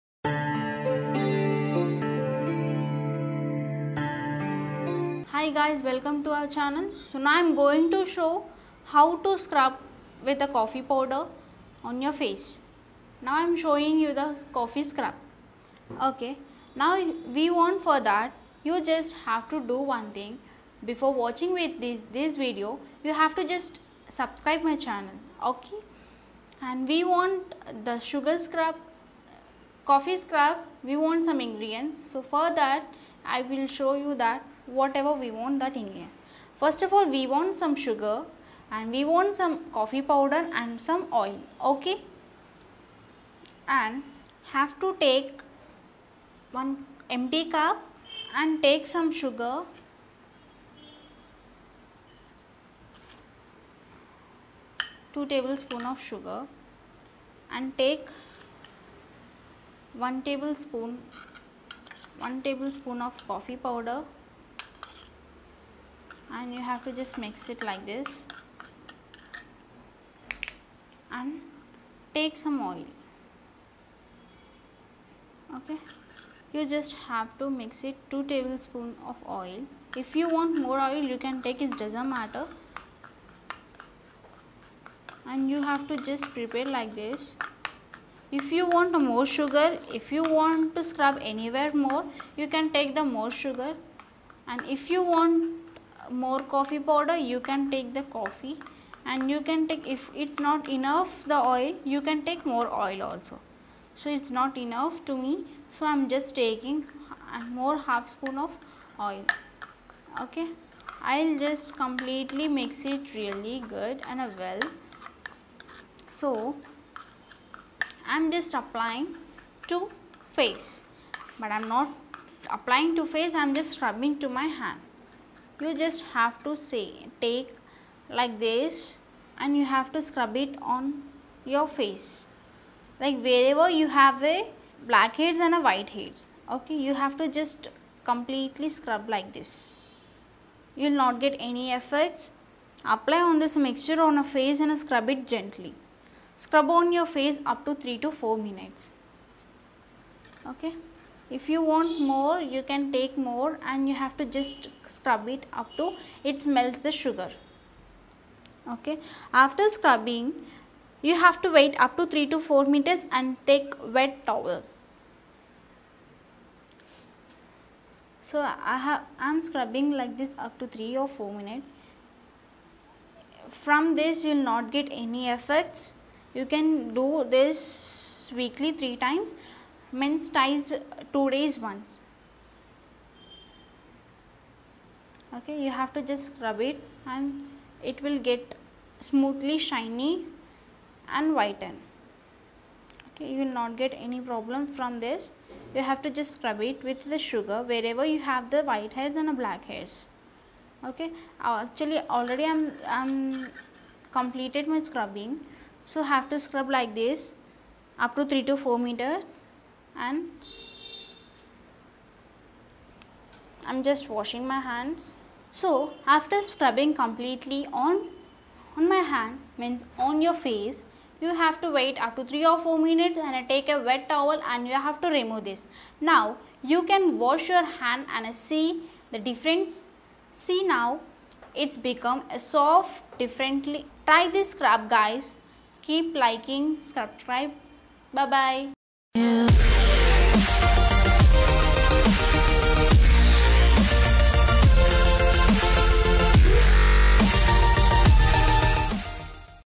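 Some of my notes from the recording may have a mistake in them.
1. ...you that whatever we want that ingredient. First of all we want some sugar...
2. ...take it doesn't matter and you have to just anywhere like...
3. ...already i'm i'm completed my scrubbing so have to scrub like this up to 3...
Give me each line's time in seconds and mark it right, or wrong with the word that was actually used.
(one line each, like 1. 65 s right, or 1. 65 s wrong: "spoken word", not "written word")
1. 33 s right
2. 81 s wrong: "prepare", not "anywhere"
3. 202 s right.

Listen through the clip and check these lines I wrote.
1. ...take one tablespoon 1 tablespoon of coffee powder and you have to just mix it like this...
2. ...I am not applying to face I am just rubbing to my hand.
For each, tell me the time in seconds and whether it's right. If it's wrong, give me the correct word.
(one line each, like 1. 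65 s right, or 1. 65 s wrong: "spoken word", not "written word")
1. 57 s right
2. 121 s right.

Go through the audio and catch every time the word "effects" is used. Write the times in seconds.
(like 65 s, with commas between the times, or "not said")
141 s, 175 s.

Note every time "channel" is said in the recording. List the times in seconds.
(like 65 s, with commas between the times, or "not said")
6 s, 24 s.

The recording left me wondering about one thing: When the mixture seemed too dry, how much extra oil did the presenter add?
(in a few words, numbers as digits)
half spoon.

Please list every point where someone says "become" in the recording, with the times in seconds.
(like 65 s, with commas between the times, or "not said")
231 s.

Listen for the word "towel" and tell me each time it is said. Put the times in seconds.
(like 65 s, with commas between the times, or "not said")
164 s, 224 s.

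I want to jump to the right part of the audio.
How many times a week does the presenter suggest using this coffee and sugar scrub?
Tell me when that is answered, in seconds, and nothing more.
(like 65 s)
178 s.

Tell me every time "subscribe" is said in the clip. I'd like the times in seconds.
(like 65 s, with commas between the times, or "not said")
24 s, 236 s.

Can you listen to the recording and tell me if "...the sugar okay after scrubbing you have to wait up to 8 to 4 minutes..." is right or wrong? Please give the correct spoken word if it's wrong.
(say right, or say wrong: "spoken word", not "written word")
wrong: "3", not "8".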